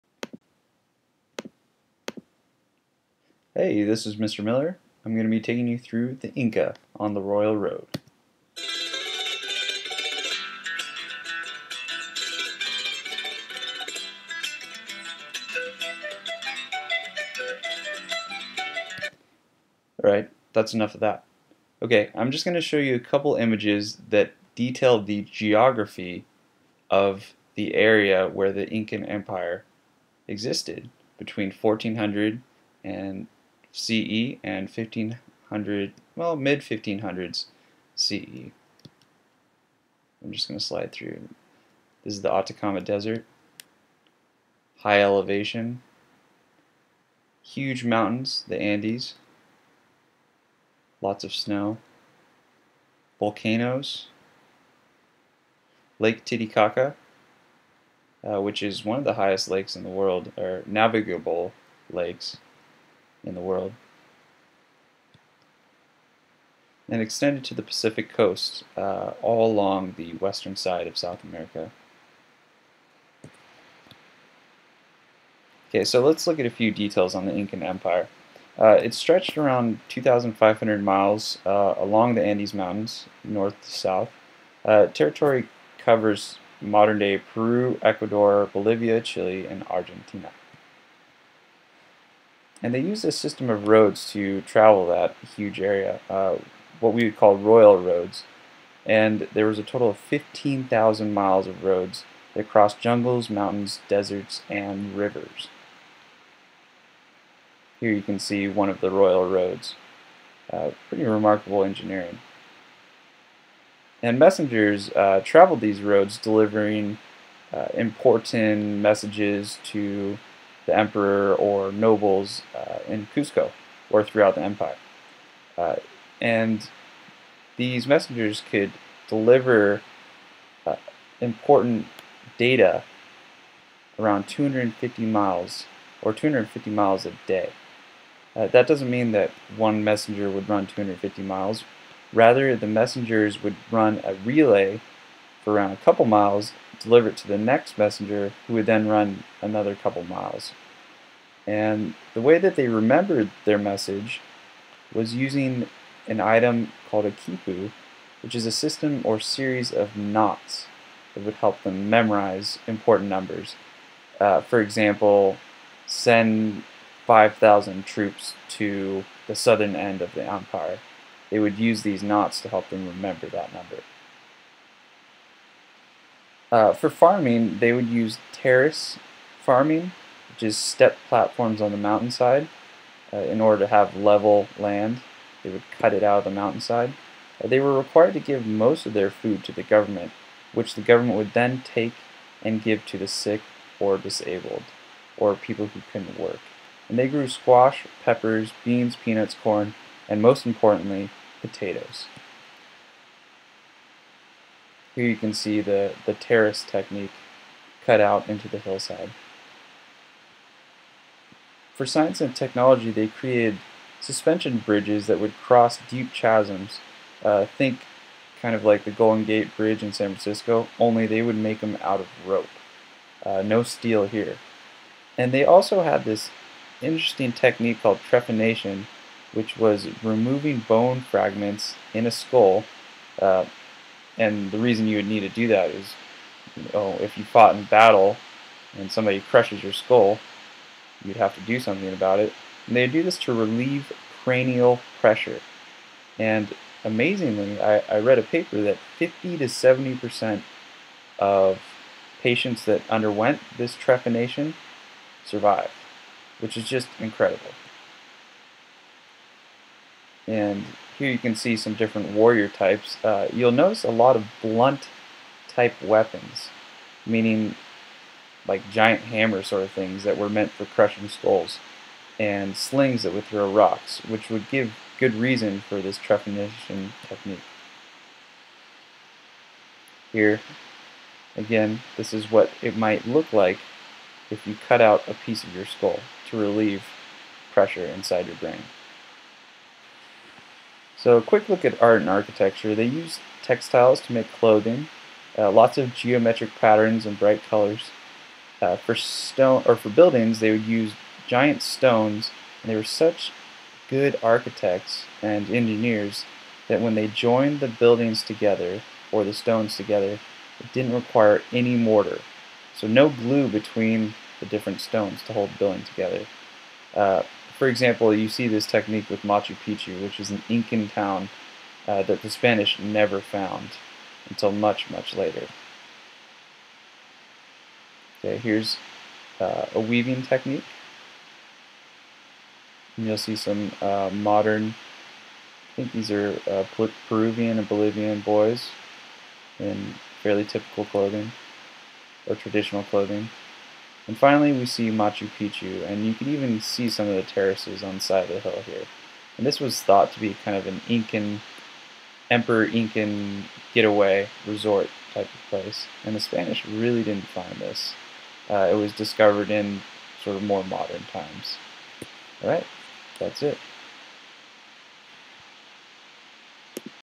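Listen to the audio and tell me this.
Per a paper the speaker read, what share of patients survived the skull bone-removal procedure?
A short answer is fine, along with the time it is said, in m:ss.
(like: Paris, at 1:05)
50 to 70 percent, at 4:08.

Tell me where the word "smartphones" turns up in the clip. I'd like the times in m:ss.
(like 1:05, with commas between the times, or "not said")
not said.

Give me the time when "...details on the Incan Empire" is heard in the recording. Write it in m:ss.
1:16.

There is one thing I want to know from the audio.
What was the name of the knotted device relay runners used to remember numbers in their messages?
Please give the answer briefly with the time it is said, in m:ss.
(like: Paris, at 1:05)
kipu, at 2:37.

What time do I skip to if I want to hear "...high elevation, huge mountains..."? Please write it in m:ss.
0:44.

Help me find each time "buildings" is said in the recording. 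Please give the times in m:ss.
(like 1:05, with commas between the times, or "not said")
4:59, 5:07, 5:15.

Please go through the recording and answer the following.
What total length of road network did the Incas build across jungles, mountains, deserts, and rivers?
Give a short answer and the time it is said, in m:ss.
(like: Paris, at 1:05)
15,000 miles, at 1:39.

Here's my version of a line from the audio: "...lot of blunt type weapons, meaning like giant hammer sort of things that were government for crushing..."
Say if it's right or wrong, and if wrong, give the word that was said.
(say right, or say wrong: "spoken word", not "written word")
wrong: "meant", not "government".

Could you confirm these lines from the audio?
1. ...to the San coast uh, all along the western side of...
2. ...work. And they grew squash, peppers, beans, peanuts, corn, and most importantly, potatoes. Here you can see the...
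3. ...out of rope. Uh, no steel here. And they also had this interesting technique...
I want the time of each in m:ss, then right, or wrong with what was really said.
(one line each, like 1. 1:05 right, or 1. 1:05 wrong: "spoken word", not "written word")
1. 1:07 wrong: "Pacific", not "San"
2. 3:16 right
3. 3:41 right.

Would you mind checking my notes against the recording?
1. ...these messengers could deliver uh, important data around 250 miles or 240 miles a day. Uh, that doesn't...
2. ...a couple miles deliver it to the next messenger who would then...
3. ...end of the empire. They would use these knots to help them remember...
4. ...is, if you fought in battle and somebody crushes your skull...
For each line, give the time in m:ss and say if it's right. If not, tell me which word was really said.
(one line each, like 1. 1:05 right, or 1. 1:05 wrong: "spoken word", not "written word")
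1. 2:07 wrong: "250", not "240"
2. 2:25 right
3. 2:49 right
4. 3:55 right.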